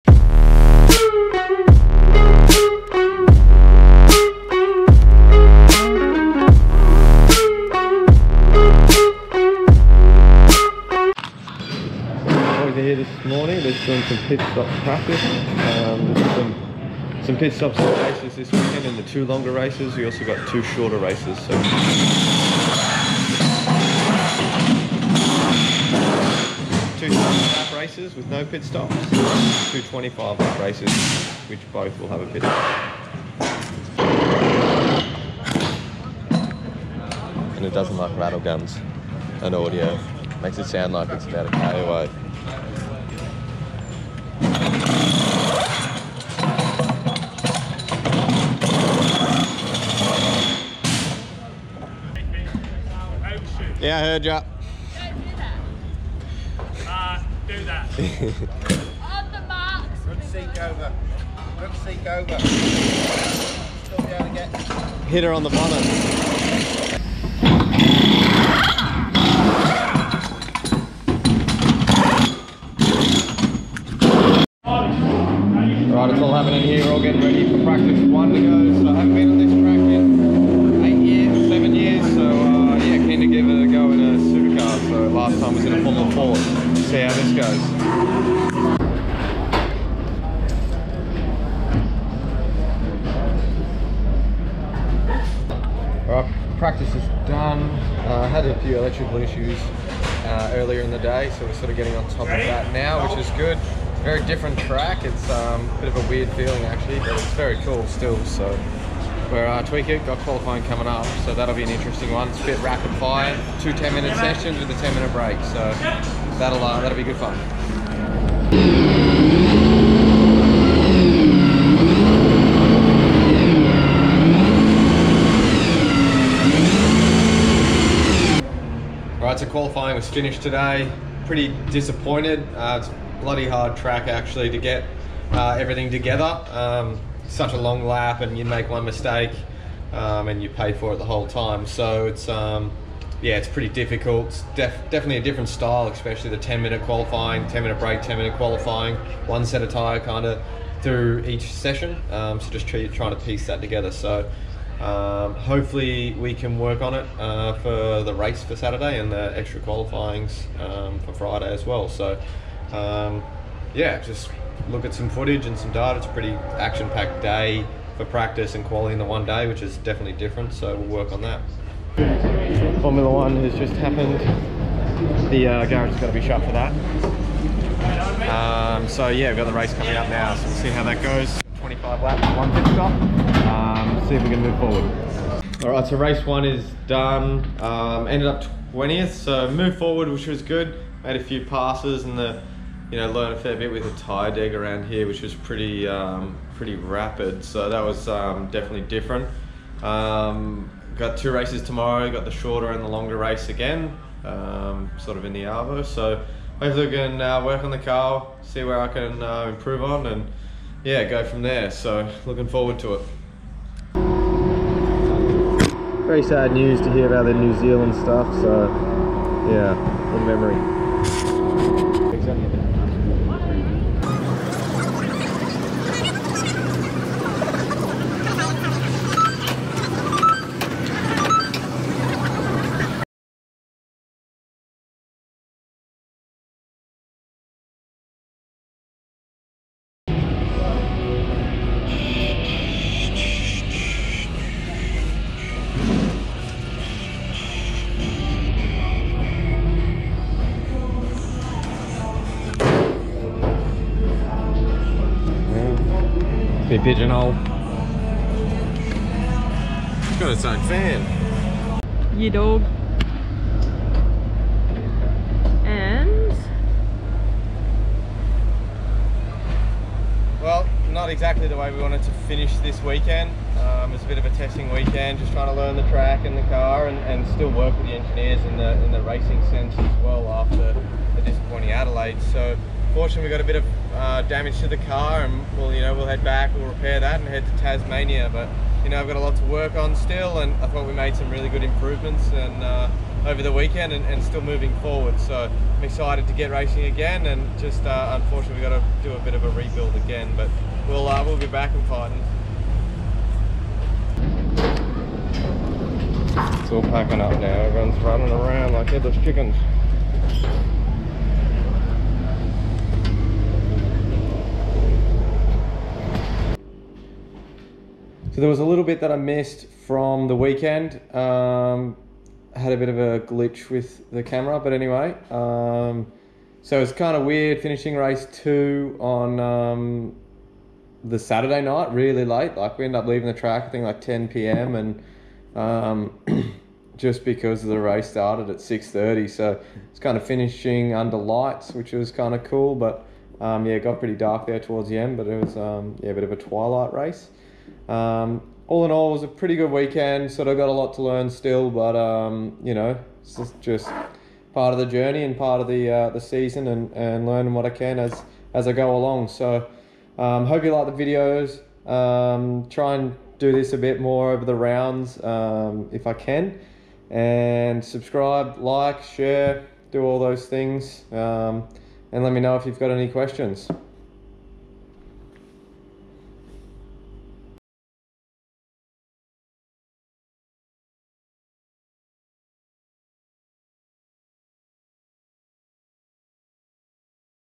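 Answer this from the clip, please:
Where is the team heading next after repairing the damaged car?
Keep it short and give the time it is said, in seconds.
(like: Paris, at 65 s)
Tasmania, at 287 s.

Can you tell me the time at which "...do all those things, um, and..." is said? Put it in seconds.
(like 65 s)
369 s.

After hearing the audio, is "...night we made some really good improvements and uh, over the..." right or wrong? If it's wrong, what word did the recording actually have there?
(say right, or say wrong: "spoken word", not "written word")
wrong: "thought", not "night".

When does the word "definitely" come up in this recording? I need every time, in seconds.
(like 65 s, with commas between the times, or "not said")
144 s, 169 s, 198 s.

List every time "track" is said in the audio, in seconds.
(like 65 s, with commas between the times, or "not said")
104 s, 133 s, 275 s, 333 s.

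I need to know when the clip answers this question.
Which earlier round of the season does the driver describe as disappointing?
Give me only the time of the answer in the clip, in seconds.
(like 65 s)
281 s.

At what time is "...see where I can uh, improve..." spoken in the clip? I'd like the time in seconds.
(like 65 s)
208 s.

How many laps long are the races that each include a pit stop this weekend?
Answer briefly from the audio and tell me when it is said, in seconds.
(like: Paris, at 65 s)
25, at 29 s.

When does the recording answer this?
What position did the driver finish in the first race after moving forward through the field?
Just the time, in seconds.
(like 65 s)
188 s.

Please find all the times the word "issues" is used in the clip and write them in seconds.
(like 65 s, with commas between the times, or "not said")
99 s.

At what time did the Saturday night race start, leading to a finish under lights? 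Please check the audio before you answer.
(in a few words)
6:30.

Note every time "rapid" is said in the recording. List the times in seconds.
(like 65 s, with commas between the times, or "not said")
112 s, 196 s.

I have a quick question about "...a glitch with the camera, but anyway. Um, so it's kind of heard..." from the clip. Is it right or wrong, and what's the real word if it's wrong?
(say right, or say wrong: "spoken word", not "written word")
wrong: "weird", not "heard".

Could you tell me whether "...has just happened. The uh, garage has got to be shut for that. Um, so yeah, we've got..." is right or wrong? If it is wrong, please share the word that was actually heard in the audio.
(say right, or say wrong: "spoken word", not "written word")
right.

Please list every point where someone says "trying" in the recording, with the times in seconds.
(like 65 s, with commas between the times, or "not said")
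152 s, 275 s.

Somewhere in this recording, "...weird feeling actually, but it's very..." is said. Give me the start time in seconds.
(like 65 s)
106 s.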